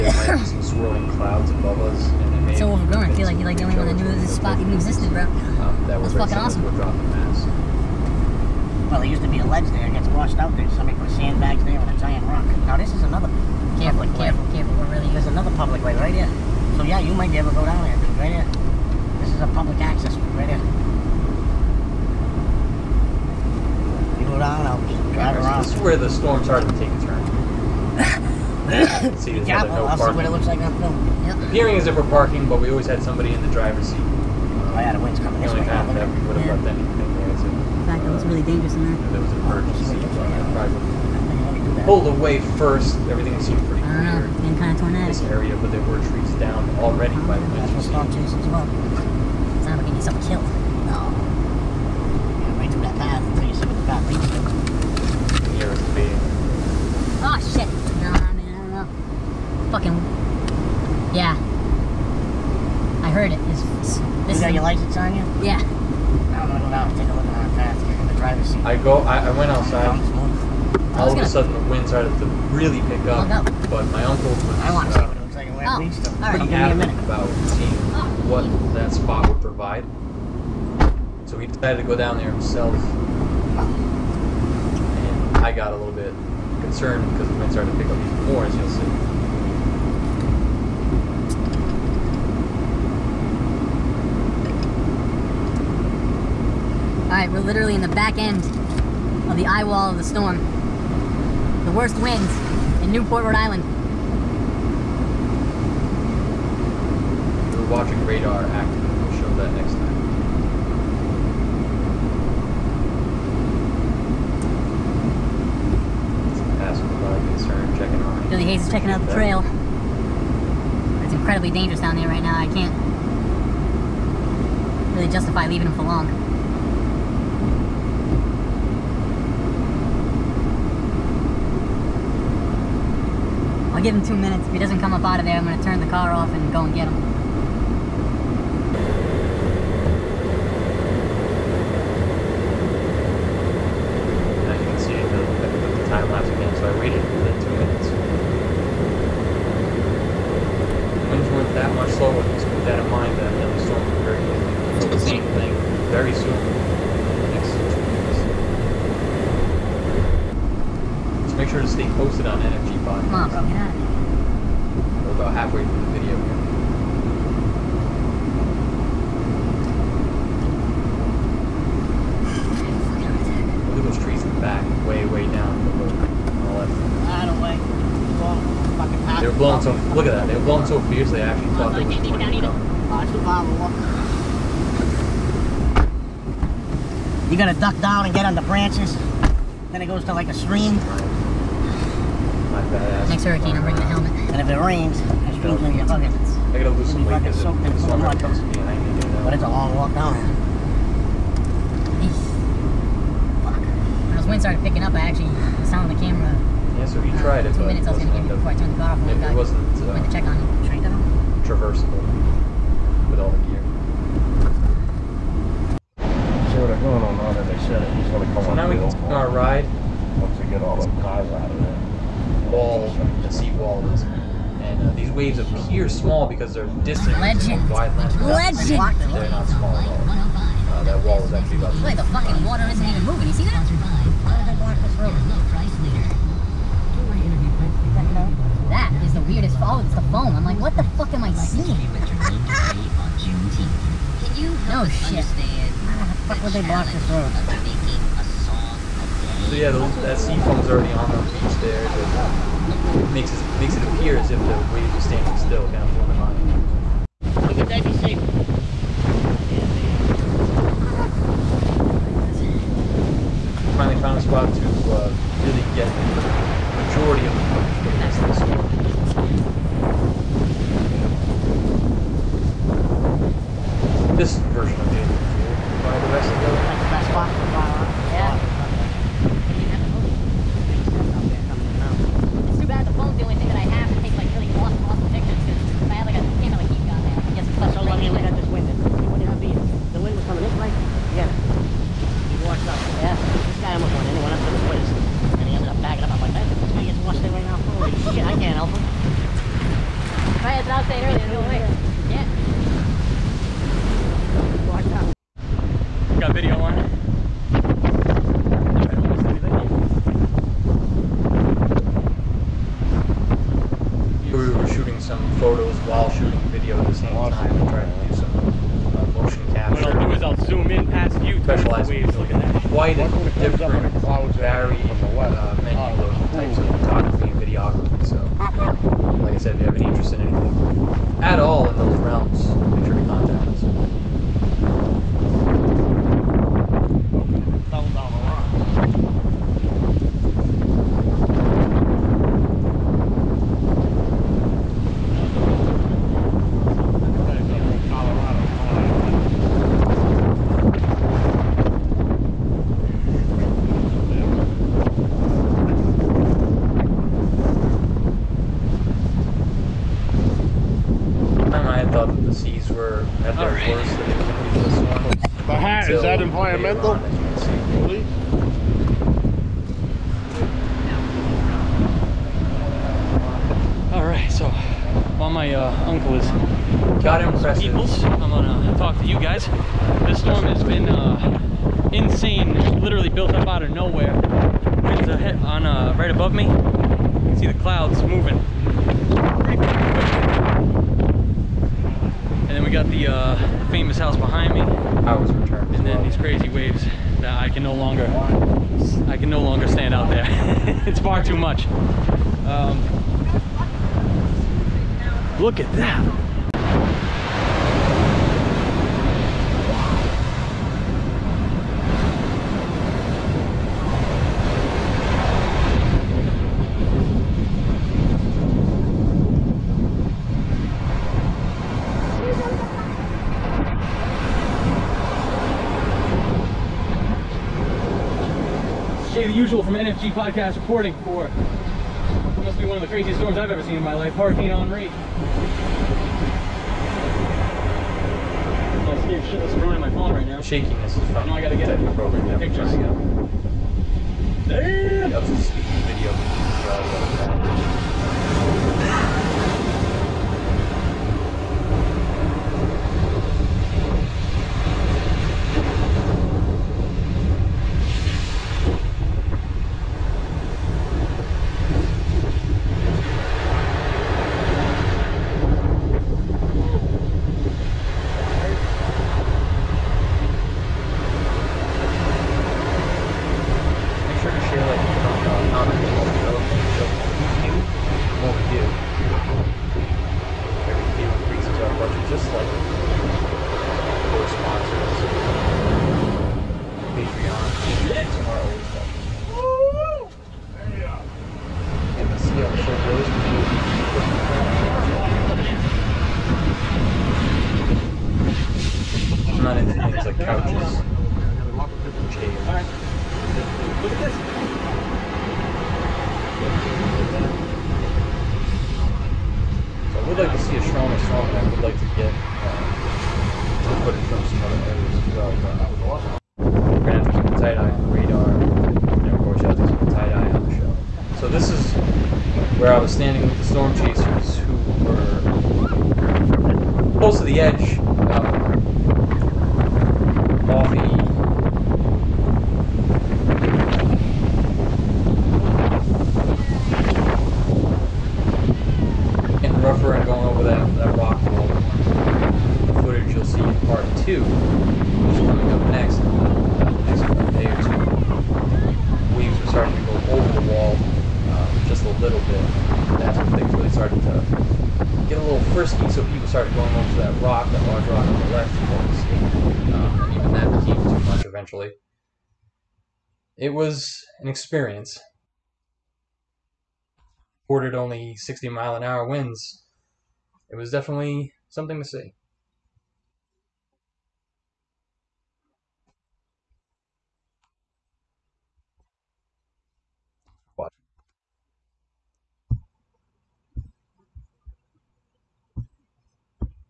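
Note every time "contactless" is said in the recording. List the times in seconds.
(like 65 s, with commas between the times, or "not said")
333 s.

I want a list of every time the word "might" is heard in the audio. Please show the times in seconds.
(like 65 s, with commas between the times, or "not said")
0 s, 17 s.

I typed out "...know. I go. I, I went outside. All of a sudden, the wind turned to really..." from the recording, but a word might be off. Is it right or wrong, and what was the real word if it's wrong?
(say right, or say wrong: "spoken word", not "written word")
wrong: "started", not "turned".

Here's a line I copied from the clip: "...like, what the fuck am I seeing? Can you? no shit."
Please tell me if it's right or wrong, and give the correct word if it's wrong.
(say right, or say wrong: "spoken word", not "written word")
right.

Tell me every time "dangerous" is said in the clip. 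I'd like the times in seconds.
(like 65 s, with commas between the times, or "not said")
38 s, 121 s.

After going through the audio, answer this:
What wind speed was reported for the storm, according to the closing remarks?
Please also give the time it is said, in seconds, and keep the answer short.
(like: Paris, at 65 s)
60 mph, at 568 s.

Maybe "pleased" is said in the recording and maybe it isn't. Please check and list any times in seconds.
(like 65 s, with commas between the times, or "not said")
not said.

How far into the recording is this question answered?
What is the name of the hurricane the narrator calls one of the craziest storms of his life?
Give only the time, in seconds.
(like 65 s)
434 s.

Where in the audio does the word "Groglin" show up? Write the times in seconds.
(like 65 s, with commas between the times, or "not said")
not said.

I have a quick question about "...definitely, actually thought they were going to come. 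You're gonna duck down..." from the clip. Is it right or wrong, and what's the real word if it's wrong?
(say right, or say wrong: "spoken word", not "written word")
wrong: "fiercely", not "definitely".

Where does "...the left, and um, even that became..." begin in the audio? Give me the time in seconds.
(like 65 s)
558 s.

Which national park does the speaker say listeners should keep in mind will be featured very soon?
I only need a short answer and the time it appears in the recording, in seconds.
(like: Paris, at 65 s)
Yellowstone, at 153 s.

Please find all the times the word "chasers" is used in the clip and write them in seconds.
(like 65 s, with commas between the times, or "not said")
523 s.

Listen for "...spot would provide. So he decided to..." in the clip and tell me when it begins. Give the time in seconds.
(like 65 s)
78 s.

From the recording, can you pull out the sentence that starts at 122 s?
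I can't really justify leaving him for long.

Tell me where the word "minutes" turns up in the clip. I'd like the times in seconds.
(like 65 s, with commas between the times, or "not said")
76 s, 134 s, 207 s.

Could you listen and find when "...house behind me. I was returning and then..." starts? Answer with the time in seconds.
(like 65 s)
393 s.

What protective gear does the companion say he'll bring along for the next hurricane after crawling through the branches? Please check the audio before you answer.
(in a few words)
Helmet.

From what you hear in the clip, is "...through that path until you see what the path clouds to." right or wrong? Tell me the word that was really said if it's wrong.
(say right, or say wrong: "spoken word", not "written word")
wrong: "leads", not "clouds".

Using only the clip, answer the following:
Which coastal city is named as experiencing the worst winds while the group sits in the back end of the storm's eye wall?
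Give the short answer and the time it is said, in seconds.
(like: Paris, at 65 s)
Newport, Rhode Island, at 102 s.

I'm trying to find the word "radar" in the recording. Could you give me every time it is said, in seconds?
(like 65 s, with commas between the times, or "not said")
108 s, 517 s.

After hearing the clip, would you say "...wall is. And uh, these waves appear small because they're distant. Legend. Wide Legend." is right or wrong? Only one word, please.
right.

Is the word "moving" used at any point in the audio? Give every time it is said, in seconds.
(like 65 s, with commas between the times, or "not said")
233 s, 388 s.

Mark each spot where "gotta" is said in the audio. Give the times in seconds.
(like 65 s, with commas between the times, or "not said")
196 s, 441 s.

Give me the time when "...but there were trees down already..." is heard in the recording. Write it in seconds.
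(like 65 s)
45 s.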